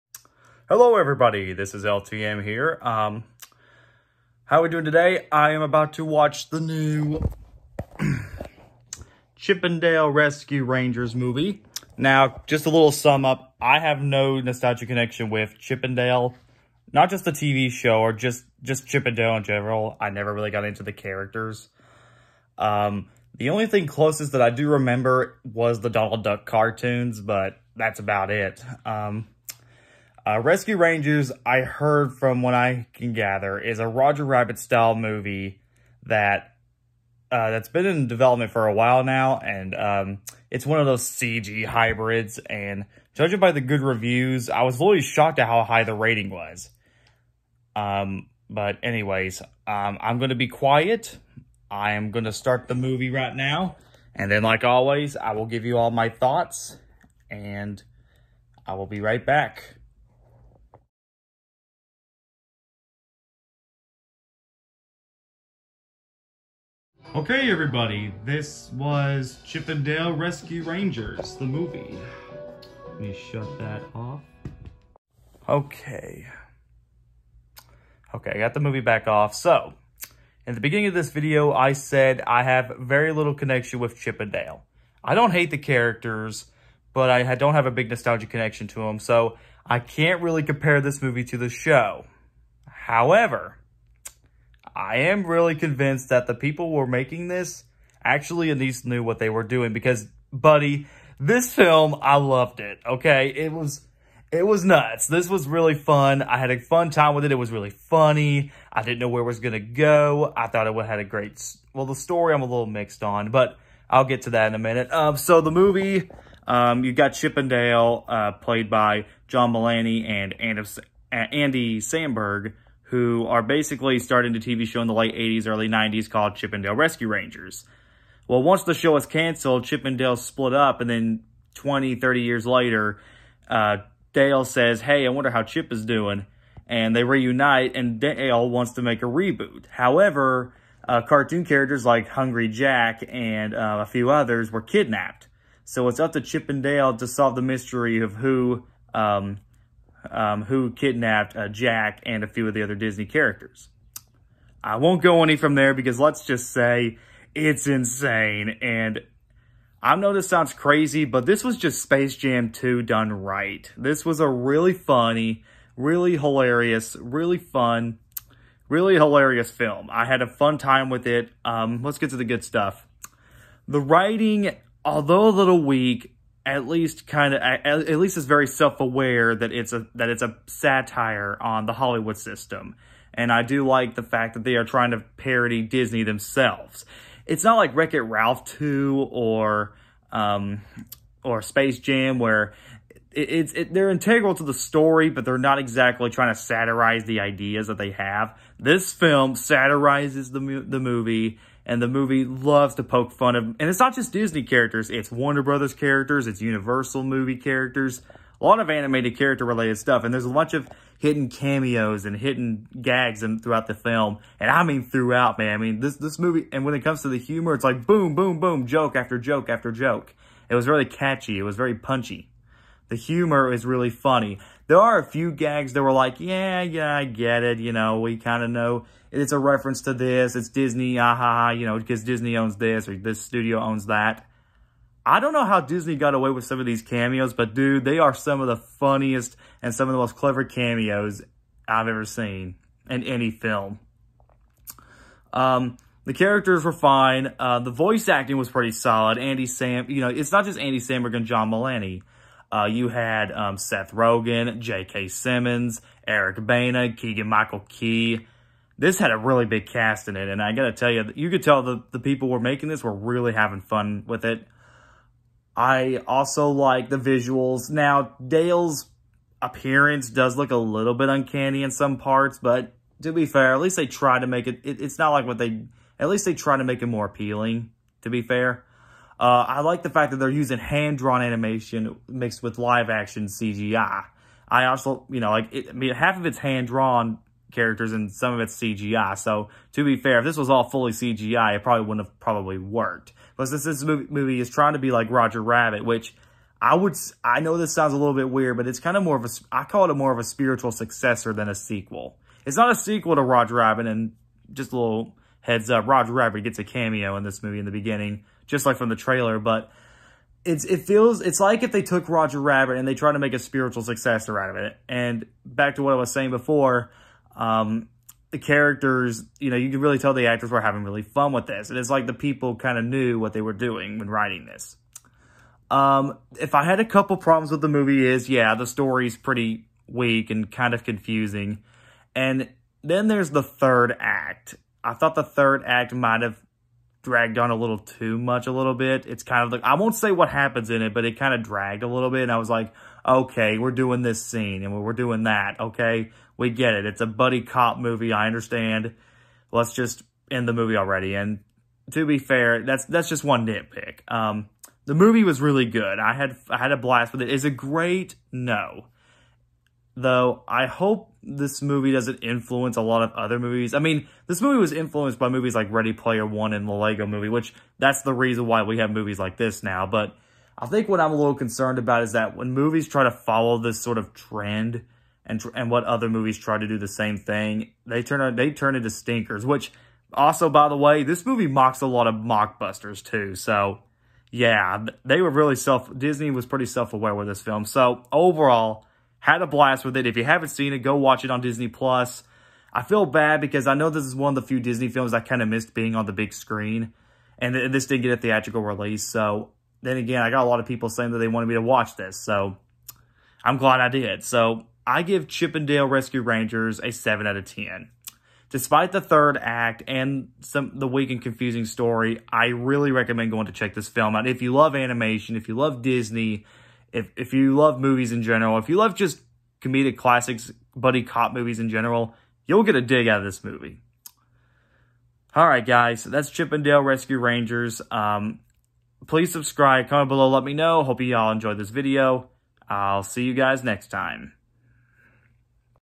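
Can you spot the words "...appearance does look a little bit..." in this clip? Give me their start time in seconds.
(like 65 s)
269 s.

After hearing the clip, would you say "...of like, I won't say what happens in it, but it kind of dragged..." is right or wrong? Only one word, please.
right.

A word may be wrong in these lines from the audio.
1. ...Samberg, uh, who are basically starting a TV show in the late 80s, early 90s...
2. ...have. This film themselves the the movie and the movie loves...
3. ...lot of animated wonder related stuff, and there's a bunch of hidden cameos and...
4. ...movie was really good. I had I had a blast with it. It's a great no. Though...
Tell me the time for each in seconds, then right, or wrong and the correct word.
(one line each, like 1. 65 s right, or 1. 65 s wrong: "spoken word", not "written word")
1. 121 s right
2. 197 s wrong: "satirizes", not "themselves"
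3. 208 s wrong: "character", not "wonder"
4. 354 s right.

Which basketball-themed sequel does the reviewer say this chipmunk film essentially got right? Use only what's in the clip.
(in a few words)
Space Jam 2.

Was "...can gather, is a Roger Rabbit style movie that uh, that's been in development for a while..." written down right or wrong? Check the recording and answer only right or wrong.
right.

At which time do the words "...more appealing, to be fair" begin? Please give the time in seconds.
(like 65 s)
276 s.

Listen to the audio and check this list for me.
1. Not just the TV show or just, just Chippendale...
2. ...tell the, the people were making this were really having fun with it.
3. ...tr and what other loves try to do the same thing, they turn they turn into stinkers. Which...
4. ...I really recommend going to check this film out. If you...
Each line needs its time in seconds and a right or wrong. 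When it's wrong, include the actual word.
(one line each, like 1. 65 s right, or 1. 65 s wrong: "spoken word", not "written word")
1. 16 s right
2. 261 s right
3. 375 s wrong: "movies", not "loves"
4. 412 s right.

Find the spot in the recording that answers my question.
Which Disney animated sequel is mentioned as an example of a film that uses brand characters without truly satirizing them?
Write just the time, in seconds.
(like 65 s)
187 s.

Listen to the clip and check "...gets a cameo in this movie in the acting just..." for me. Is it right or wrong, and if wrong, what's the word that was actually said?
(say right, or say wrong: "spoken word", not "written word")
wrong: "beginning", not "acting".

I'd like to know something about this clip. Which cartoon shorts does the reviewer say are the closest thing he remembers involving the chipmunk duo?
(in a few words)
Donald Duck cartoons.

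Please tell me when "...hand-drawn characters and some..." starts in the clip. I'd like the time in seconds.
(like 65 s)
286 s.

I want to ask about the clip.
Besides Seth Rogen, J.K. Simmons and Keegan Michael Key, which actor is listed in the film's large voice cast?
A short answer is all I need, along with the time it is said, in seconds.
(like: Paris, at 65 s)
Eric Bana, at 256 s.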